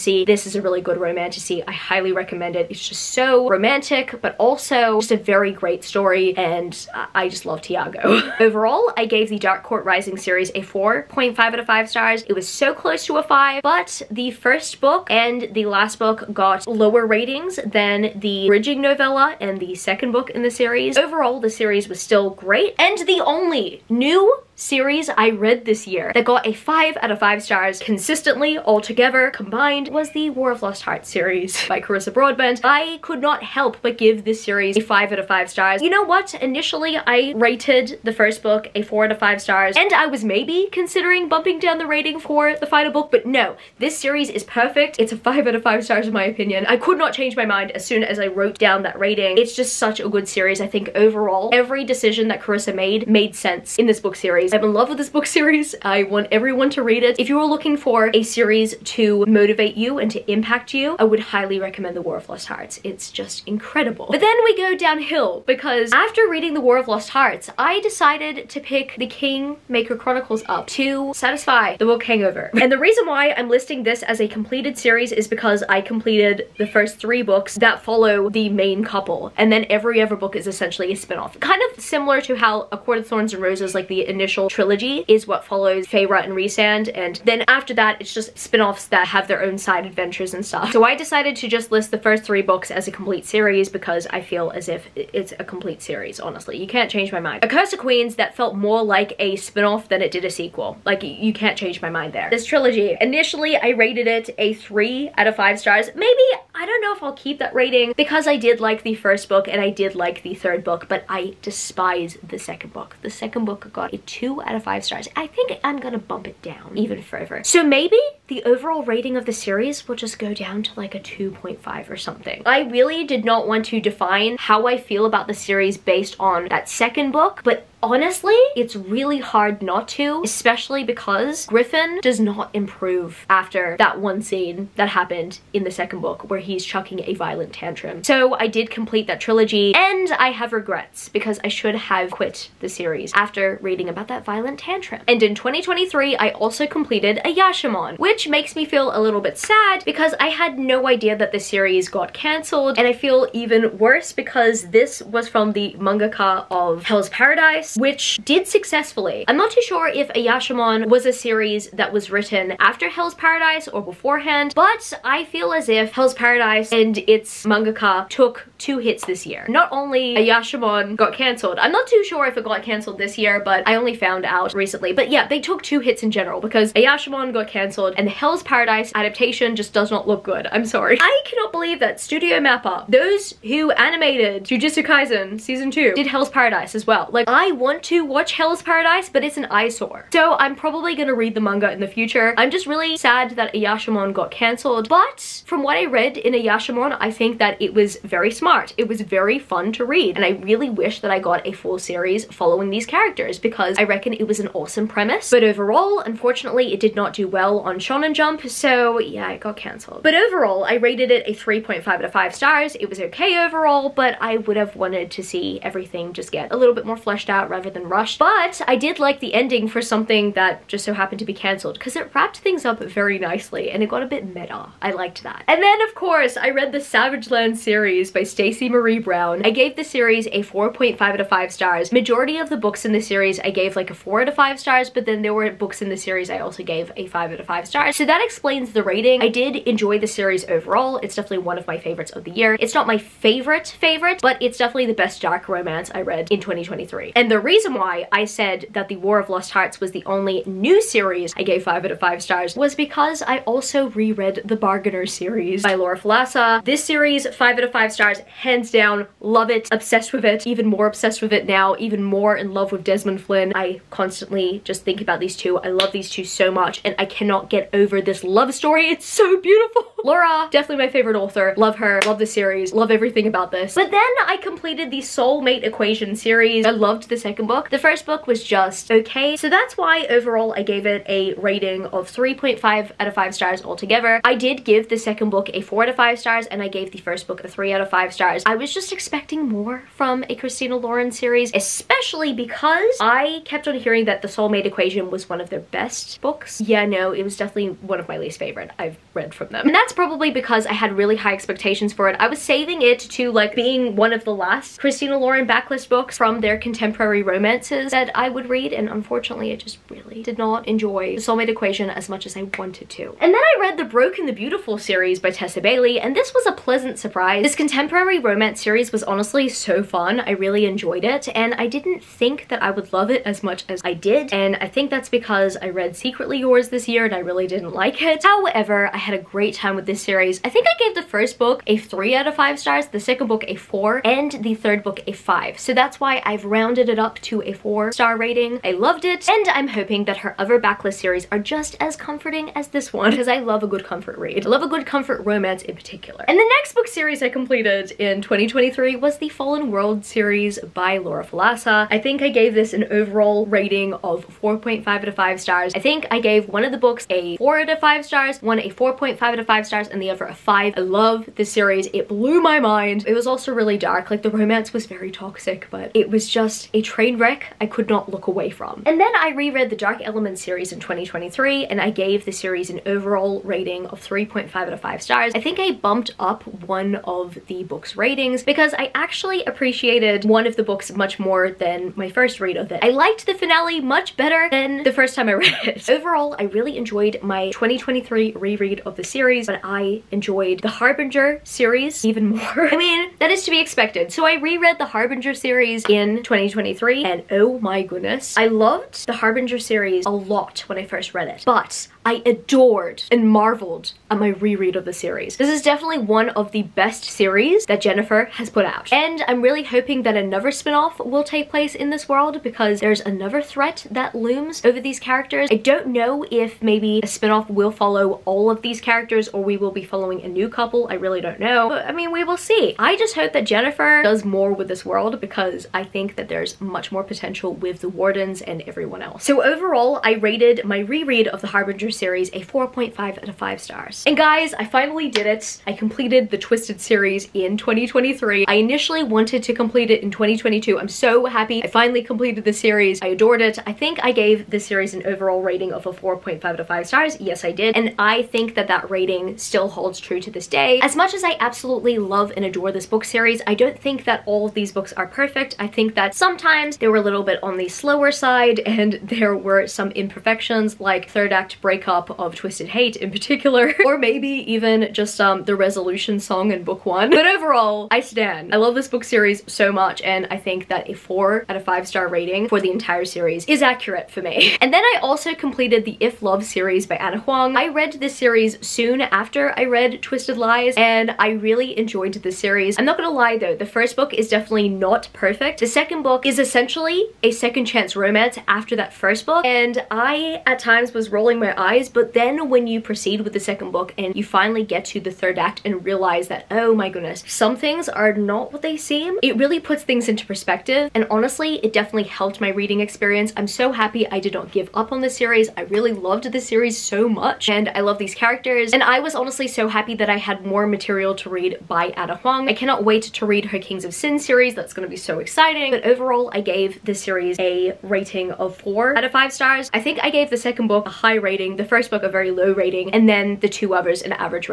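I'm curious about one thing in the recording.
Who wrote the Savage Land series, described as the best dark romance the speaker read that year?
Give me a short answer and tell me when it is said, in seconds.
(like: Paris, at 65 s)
Stacey Marie Brown, at 228 s.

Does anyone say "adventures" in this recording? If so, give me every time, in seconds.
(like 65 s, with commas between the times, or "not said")
89 s, 431 s.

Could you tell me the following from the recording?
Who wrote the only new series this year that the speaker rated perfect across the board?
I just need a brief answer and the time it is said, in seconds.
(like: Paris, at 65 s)
Carissa Broadbent, at 31 s.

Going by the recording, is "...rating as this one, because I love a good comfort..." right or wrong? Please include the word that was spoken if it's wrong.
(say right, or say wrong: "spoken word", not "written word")
wrong: "comforting", not "rating".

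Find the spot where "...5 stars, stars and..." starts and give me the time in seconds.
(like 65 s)
359 s.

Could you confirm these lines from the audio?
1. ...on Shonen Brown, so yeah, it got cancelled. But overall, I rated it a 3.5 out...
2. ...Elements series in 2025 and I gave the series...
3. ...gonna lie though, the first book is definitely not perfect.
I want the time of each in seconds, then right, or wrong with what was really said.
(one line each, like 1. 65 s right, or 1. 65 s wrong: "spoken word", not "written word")
1. 207 s wrong: "Jump", not "Brown"
2. 370 s wrong: "2023", not "2025"
3. 482 s right.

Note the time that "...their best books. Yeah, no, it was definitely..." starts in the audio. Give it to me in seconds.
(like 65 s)
295 s.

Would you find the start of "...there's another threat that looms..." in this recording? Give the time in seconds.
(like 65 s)
412 s.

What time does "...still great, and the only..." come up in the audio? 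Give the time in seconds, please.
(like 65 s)
22 s.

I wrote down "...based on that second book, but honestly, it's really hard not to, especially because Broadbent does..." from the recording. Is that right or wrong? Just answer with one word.
wrong.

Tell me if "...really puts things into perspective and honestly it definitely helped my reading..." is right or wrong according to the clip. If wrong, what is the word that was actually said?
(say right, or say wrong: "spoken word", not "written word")
right.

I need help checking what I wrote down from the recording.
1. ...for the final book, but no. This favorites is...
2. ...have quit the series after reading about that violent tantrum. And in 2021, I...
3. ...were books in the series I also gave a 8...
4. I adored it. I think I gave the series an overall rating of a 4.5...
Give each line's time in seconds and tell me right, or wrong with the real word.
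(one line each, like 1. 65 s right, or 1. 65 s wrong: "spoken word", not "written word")
1. 42 s wrong: "series", not "favorites"
2. 141 s wrong: "2023", not "2021"
3. 235 s wrong: "5", not "8"
4. 443 s right.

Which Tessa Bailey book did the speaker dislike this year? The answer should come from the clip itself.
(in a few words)
Secretly Yours.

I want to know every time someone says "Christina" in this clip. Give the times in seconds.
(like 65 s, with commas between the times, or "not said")
290 s, 304 s.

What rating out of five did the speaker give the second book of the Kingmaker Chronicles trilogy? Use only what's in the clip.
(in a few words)
2.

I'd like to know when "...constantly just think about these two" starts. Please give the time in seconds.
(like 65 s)
263 s.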